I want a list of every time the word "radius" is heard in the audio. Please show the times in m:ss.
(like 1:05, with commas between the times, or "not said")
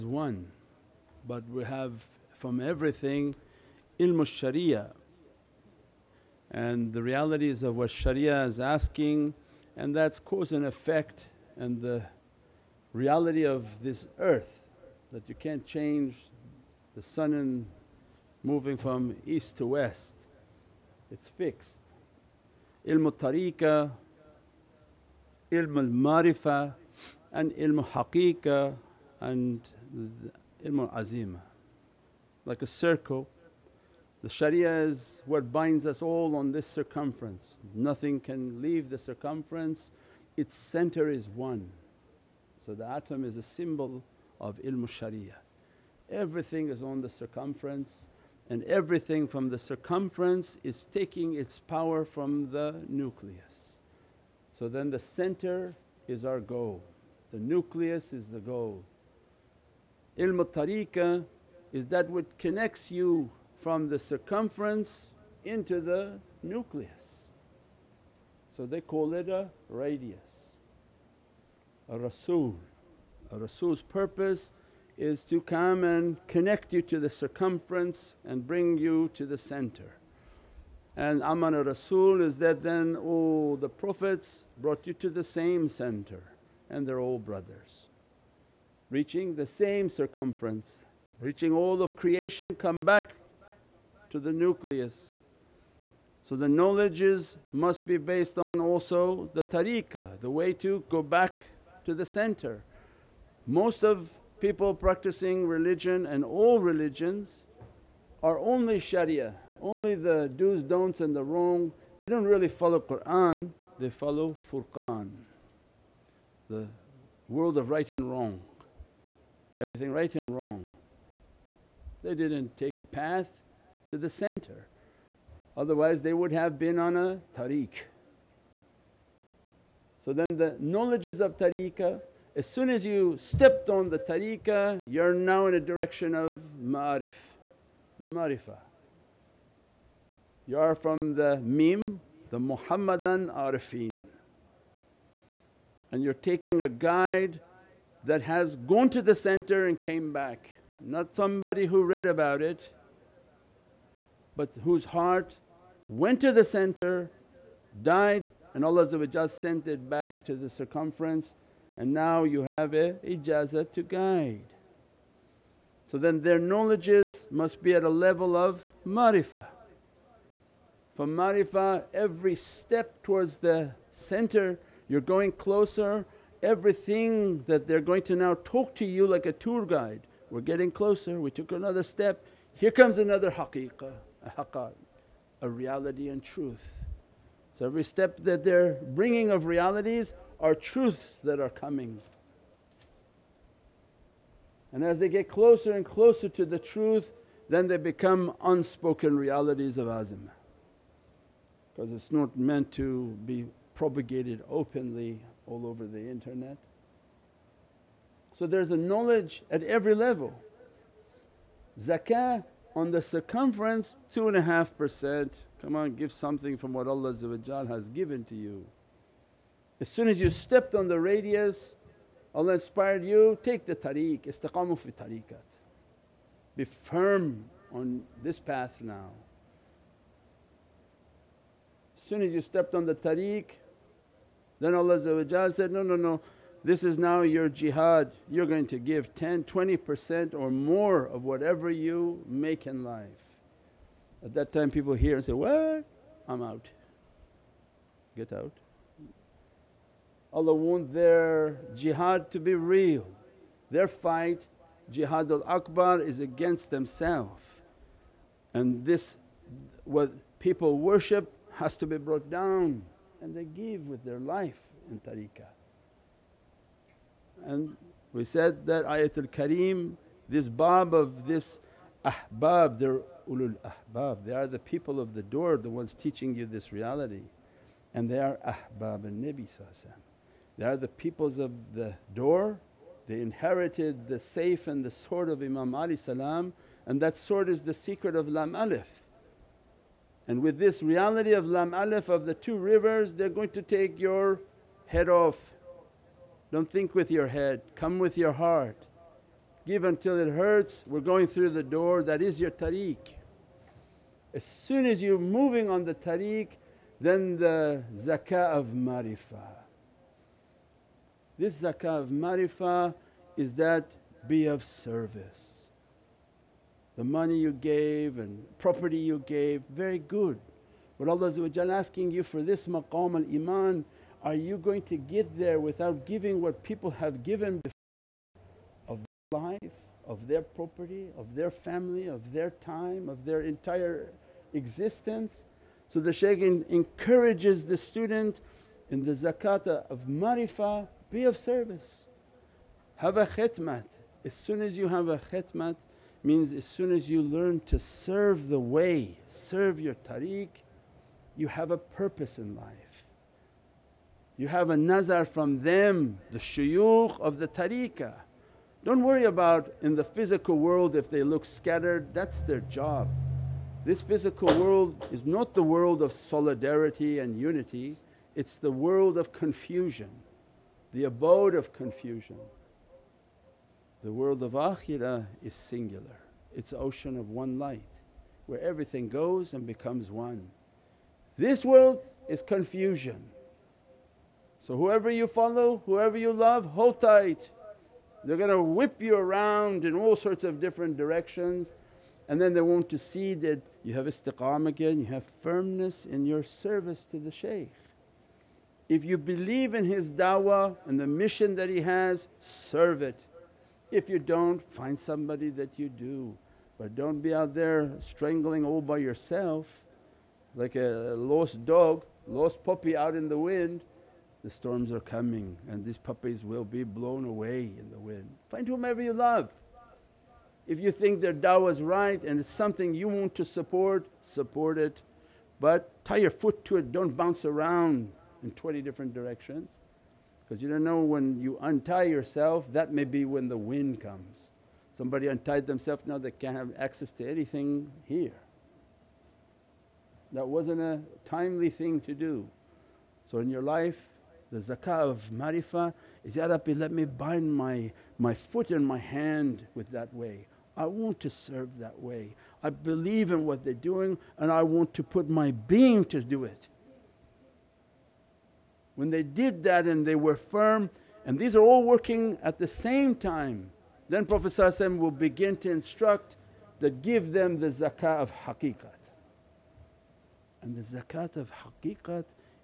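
1:09, 3:40.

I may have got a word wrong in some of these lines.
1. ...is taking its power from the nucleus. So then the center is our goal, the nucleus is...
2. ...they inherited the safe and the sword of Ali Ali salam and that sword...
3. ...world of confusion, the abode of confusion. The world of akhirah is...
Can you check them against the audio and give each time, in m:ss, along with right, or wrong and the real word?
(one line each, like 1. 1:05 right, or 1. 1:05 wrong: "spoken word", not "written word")
1. 0:50 right
2. 4:43 wrong: "Imam", not "Ali"
3. 6:08 right.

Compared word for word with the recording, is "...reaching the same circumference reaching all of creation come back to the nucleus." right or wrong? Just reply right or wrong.
right.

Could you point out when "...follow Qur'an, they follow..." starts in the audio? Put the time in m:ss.
1:52.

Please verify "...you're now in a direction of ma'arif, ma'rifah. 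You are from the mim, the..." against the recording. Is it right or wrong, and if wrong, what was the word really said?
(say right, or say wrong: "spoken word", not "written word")
right.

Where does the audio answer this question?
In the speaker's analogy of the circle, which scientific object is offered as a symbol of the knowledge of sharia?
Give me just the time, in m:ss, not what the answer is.
0:42.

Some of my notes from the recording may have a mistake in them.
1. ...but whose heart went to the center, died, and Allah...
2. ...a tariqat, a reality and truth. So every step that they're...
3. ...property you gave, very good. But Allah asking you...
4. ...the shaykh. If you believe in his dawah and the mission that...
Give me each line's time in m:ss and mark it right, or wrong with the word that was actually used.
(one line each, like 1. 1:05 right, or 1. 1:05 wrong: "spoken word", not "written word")
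1. 2:34 right
2. 3:04 wrong: "haqqat", not "tariqat"
3. 5:18 right
4. 6:37 right.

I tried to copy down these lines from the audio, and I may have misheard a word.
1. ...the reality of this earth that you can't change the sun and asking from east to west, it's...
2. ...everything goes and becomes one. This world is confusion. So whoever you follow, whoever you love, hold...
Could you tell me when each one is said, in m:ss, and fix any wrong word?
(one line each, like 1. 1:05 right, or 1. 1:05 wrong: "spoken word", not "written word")
1. 0:11 wrong: "moving", not "asking"
2. 6:18 right.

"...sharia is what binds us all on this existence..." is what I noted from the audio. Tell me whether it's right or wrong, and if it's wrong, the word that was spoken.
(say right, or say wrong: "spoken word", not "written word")
wrong: "circumference", not "existence".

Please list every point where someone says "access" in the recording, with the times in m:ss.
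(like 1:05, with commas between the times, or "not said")
7:16.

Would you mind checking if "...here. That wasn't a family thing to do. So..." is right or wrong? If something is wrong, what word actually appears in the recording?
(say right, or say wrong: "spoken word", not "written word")
wrong: "timely", not "family".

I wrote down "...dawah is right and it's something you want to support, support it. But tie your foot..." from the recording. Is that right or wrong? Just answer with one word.
right.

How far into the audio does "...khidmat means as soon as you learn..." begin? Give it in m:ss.
5:45.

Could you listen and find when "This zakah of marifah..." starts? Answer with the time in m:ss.
5:11.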